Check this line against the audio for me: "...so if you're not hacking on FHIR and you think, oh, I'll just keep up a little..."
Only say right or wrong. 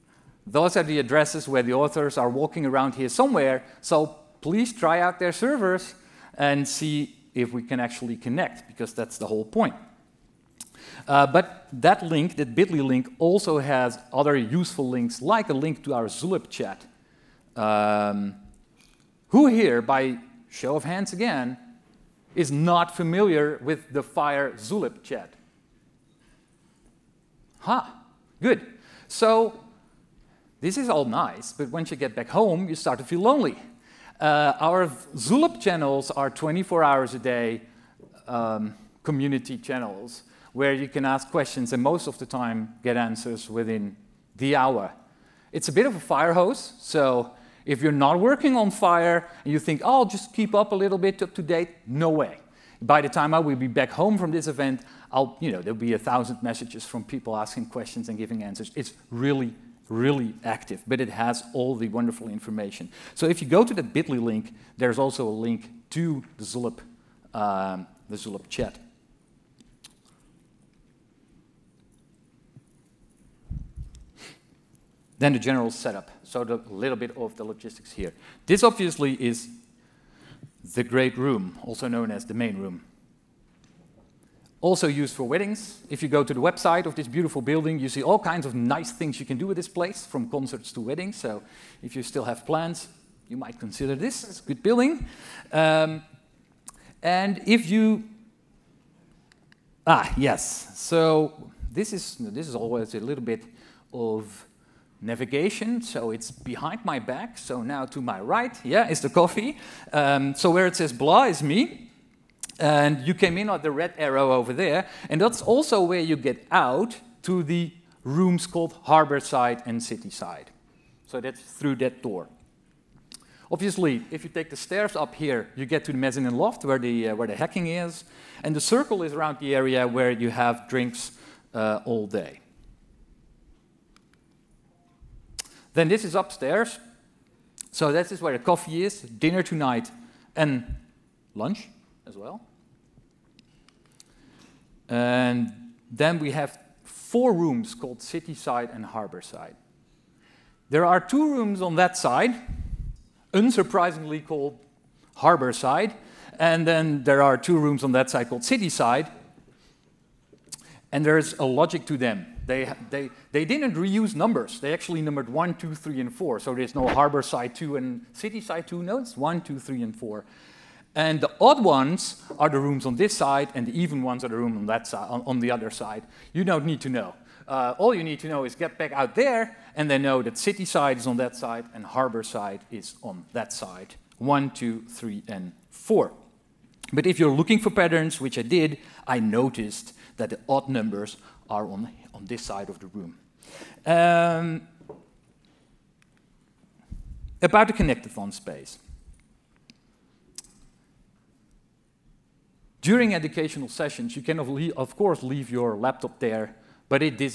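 wrong.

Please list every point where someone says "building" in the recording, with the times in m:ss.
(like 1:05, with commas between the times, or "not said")
1:27, 1:34.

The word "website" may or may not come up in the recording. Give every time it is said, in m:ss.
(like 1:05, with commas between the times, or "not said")
1:26.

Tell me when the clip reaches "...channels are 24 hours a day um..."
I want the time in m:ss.
0:35.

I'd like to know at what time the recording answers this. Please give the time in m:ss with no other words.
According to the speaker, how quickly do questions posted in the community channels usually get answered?
0:43.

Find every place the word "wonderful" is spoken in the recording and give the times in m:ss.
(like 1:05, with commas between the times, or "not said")
1:01.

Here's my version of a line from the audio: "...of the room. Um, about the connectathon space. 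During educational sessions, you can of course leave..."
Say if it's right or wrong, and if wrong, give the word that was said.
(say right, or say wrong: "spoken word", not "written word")
right.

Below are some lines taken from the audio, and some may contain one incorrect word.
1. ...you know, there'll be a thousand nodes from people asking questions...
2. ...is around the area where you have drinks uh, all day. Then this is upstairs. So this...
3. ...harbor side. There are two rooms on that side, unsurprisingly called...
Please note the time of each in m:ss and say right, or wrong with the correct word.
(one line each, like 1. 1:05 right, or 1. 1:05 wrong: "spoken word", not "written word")
1. 0:55 wrong: "messages", not "nodes"
2. 2:09 right
3. 2:28 right.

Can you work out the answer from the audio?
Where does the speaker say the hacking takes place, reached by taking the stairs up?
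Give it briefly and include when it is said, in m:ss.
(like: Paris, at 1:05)
Mezzanine loft, at 2:05.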